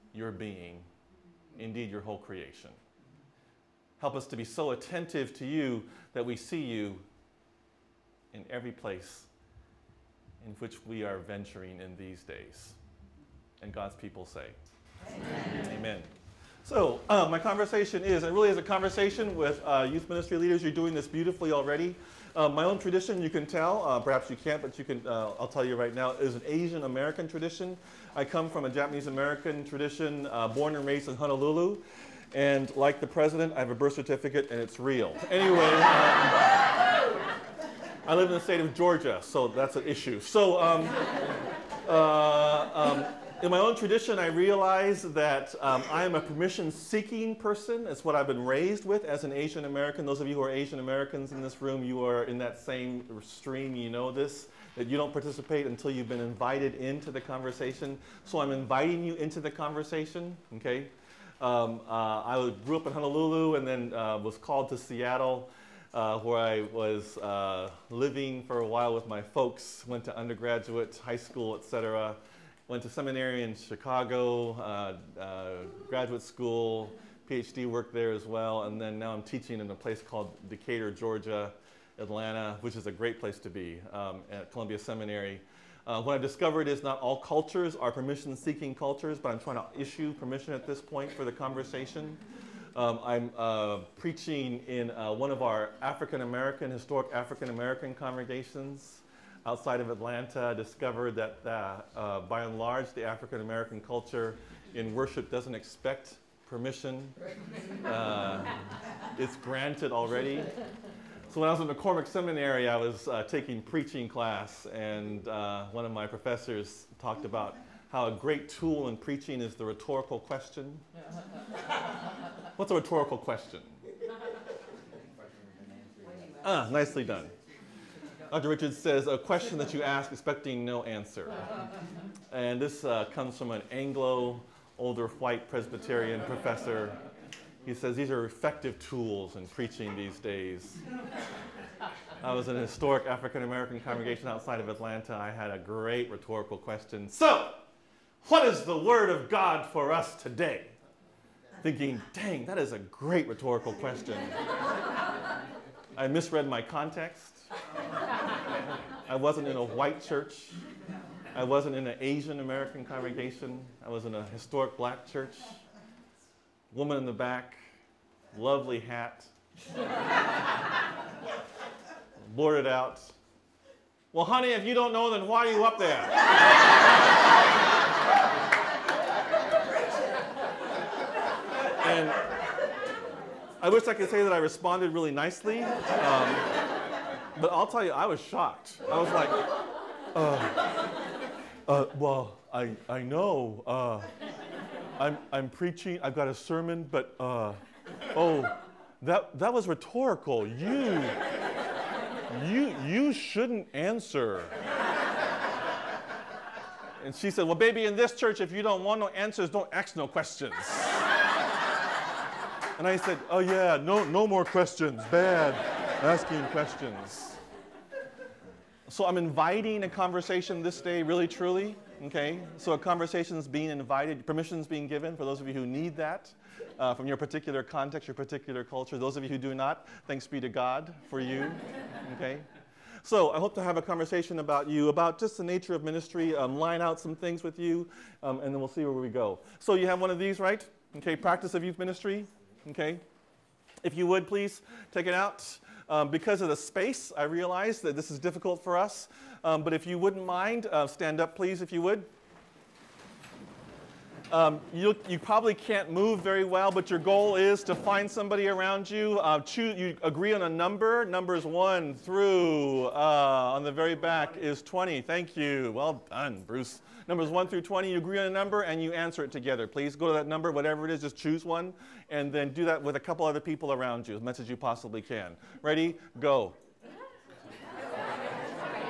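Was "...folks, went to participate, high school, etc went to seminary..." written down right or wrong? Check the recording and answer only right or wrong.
wrong.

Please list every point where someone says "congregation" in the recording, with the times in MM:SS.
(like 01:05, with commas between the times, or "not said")
01:37, 02:23, 02:42.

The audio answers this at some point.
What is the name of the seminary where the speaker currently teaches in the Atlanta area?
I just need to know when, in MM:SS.
01:24.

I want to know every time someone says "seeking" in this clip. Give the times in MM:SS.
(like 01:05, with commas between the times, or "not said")
00:46, 01:27.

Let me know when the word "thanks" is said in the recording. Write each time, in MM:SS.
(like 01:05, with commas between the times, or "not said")
03:50, 04:25.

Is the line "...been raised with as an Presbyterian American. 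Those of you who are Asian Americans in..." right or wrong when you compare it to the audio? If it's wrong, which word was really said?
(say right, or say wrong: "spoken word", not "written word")
wrong: "Asian", not "Presbyterian".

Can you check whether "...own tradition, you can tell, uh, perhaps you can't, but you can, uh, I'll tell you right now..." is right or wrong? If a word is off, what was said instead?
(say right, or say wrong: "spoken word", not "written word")
right.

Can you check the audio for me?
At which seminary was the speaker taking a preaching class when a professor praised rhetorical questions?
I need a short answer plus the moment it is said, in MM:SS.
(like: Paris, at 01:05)
McCormick Seminary, at 01:51.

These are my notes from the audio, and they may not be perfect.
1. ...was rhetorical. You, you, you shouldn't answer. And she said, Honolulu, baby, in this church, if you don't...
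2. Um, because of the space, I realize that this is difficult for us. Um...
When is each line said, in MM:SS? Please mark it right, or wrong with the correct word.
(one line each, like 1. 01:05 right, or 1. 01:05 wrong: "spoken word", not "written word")
1. 03:19 wrong: "Well", not "Honolulu"
2. 04:05 right.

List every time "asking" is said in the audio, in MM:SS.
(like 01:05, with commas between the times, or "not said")
03:36.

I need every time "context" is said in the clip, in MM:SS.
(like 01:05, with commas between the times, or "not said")
02:36, 03:47.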